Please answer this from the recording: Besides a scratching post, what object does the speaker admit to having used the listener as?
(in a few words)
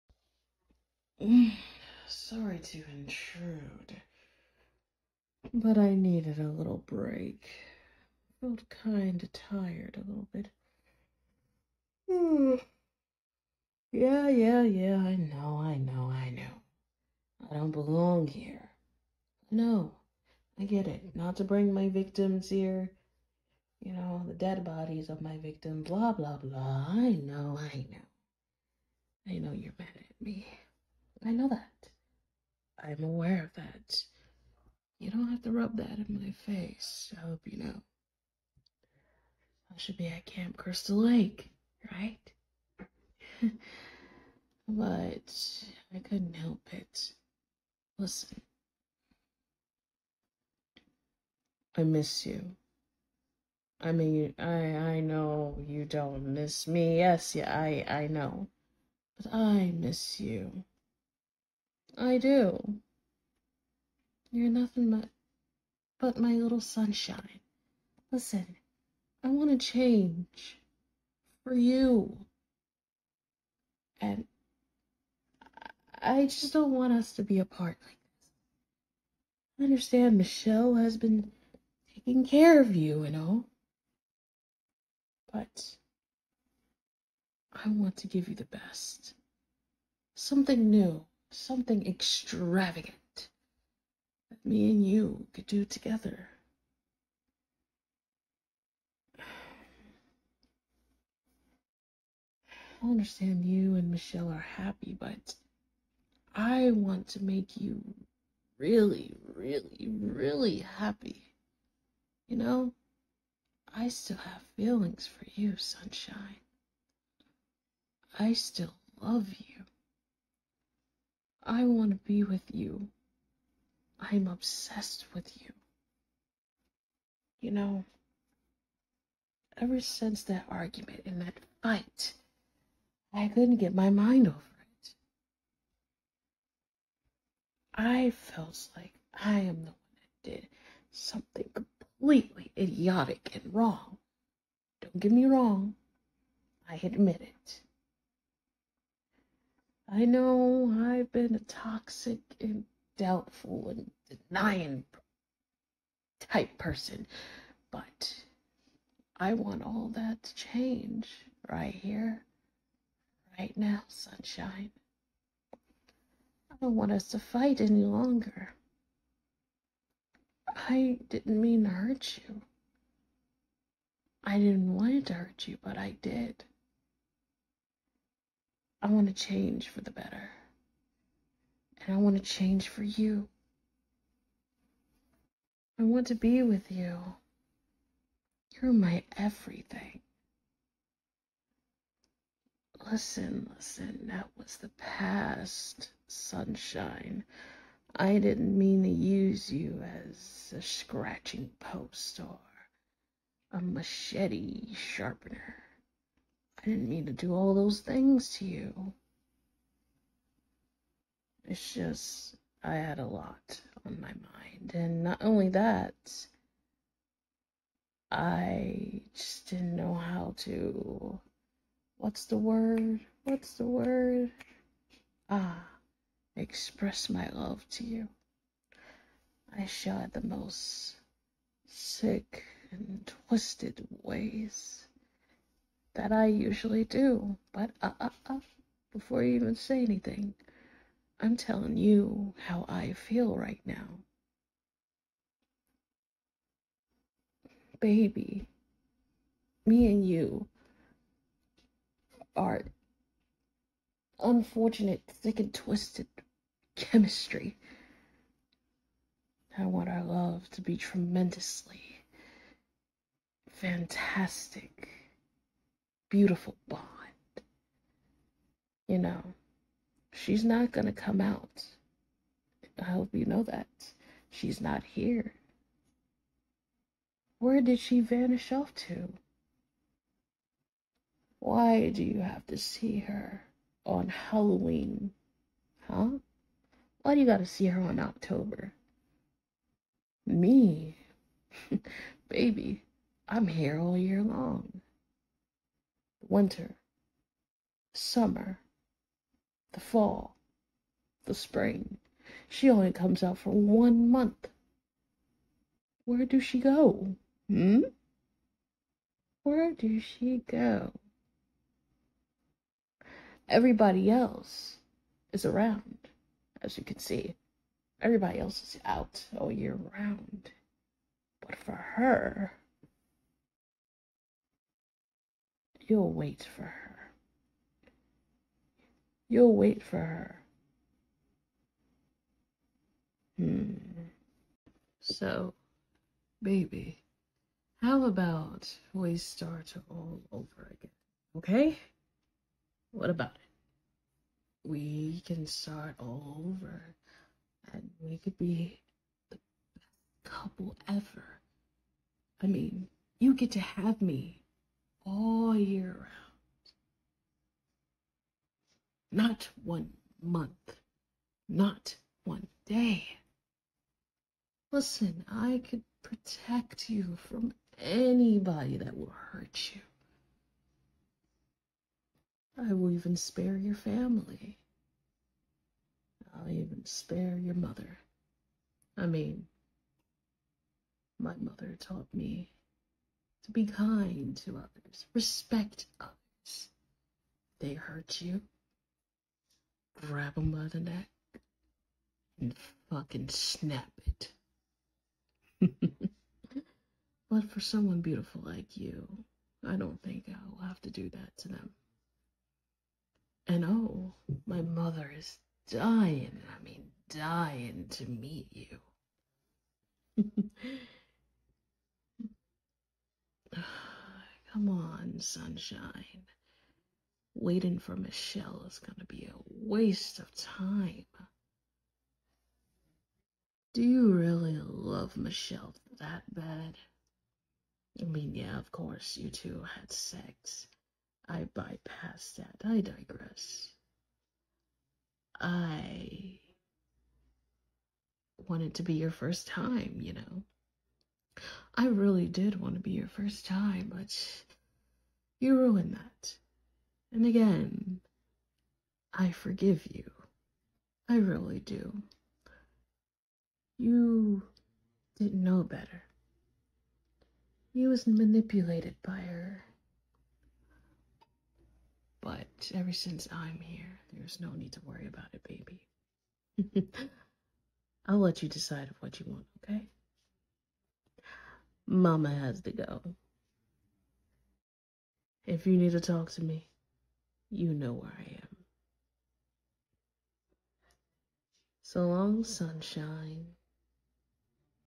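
a machete sharpener.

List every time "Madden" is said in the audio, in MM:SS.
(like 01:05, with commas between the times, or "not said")
not said.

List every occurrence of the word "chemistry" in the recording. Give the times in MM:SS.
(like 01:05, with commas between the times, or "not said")
04:16.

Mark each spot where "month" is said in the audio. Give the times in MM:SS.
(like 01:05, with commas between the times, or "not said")
05:04, 06:00.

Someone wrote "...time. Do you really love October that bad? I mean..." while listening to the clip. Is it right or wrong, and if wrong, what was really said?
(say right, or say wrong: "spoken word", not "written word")
wrong: "Michelle", not "October".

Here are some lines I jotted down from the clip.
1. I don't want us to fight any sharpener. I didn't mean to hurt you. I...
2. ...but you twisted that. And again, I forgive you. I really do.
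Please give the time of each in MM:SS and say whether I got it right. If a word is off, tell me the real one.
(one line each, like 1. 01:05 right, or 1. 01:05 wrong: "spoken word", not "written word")
1. 02:46 wrong: "longer", not "sharpener"
2. 07:23 wrong: "ruined", not "twisted".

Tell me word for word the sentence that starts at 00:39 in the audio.
I should be at Camp Crystal Lake, right?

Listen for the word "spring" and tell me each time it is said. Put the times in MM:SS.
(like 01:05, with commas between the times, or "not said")
05:01.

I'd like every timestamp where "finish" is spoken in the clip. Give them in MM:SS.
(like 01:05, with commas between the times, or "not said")
not said.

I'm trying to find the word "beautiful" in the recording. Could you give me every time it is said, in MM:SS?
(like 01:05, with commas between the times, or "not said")
04:26, 06:38.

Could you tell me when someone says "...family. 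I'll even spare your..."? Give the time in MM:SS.
06:13.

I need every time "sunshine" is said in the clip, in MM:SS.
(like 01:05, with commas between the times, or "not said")
01:06, 01:55, 02:43, 03:16, 06:55, 08:02.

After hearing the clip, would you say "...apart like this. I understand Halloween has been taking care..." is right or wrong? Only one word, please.
wrong.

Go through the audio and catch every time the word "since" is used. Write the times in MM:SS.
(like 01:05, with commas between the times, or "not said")
02:09, 07:42.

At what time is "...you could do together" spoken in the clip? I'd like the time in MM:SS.
01:34.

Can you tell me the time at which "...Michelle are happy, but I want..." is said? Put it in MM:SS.
01:43.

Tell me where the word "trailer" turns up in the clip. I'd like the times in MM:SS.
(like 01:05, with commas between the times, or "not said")
not said.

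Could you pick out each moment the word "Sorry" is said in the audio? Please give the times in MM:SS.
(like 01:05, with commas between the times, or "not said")
00:02.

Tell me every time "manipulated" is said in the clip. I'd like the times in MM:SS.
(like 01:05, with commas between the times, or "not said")
07:38.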